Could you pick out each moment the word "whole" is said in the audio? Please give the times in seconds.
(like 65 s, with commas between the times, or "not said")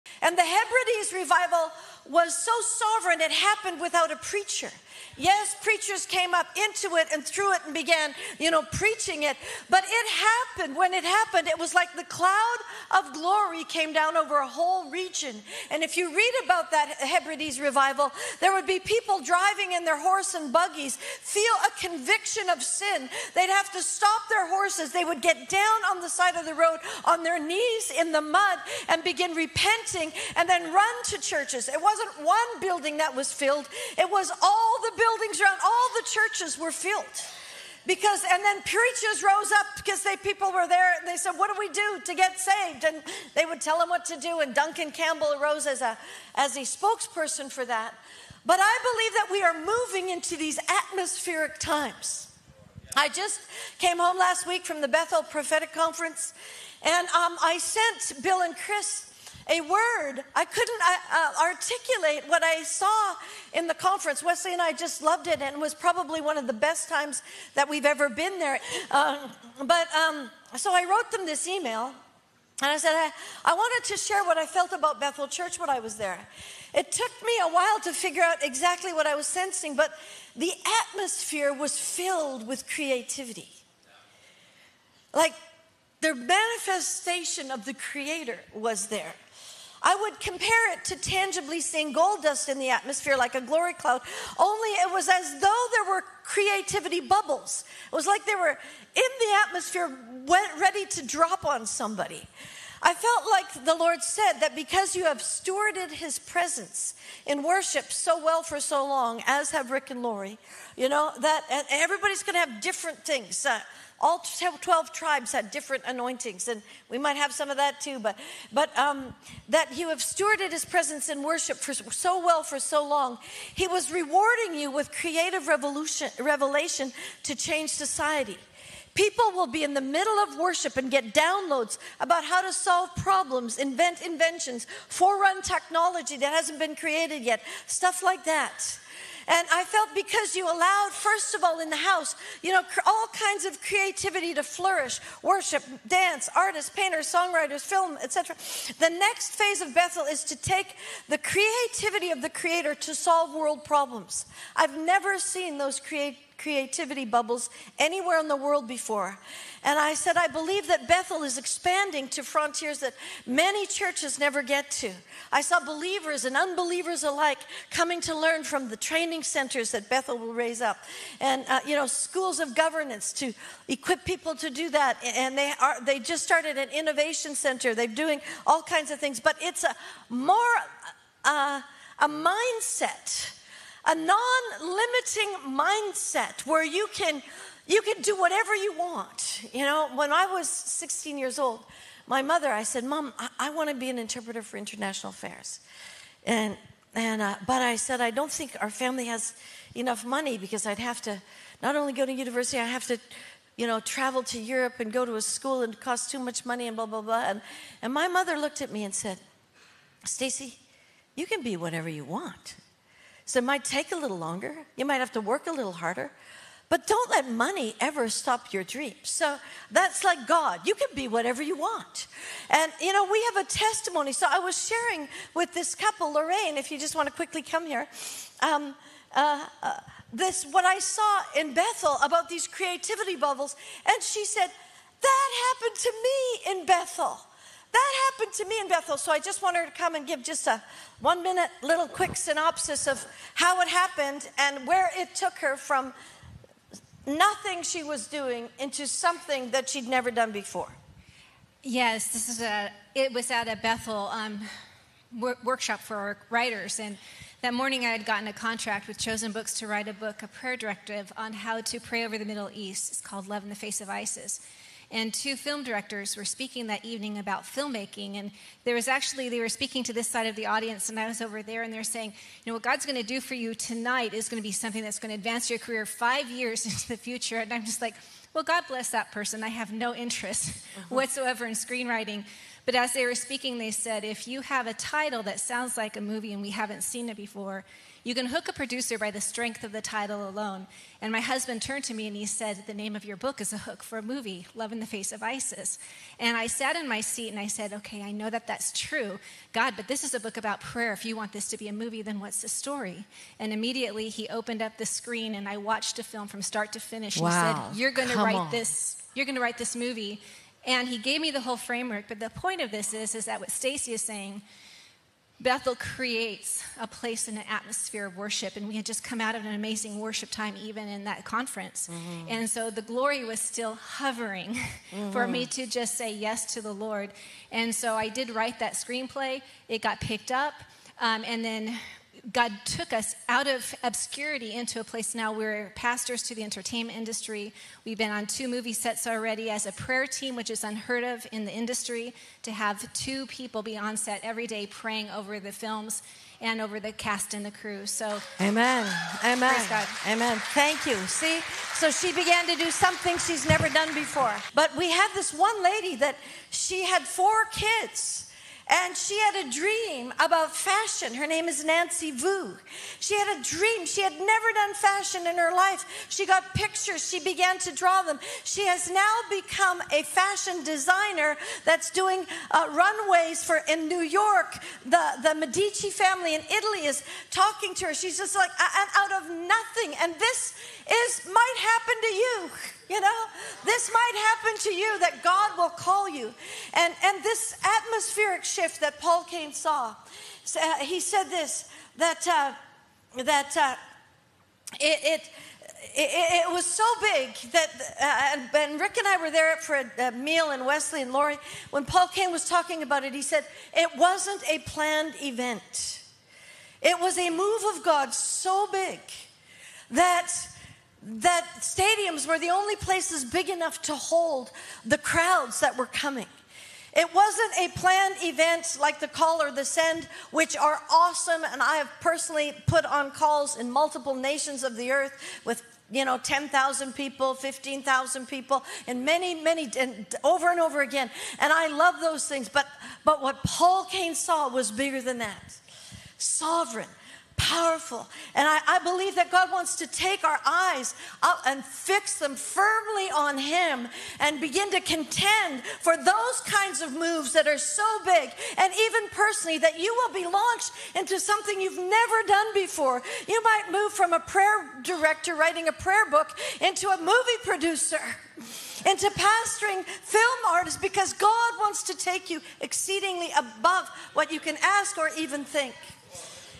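14 s, 311 s.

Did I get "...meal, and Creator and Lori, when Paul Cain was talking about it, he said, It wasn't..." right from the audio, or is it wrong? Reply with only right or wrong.
wrong.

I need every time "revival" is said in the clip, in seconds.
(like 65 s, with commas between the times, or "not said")
1 s, 17 s.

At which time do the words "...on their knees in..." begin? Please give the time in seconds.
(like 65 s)
27 s.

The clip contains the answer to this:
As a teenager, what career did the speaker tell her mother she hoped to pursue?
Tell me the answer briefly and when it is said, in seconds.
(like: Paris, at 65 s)
interpreter for international affairs, at 193 s.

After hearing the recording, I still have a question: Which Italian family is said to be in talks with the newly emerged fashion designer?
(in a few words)
the Medici family.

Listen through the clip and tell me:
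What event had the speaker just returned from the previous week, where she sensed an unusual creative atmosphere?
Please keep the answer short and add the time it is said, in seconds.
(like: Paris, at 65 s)
Bethel Prophetic Conference, at 54 s.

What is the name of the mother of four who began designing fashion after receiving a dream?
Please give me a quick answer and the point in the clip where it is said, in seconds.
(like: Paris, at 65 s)
Nancy Vu, at 361 s.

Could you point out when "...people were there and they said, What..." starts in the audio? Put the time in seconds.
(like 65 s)
40 s.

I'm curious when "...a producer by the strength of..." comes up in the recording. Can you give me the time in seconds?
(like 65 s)
288 s.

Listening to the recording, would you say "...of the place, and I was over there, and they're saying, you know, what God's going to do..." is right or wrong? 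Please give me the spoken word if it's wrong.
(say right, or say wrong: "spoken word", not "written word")
wrong: "audience", not "place".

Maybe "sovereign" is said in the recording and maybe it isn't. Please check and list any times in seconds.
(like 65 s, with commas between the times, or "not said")
2 s, 436 s.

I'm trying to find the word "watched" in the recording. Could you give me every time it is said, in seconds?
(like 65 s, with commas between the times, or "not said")
305 s.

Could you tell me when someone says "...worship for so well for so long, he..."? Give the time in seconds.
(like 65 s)
121 s.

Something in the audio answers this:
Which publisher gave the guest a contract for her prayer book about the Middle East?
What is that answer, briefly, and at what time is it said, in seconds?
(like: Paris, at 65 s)
Chosen Books, at 258 s.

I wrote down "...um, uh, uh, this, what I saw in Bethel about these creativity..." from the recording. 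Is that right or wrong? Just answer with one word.
right.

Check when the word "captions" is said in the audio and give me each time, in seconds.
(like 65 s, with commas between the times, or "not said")
not said.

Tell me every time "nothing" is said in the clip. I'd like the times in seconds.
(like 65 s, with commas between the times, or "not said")
247 s, 379 s.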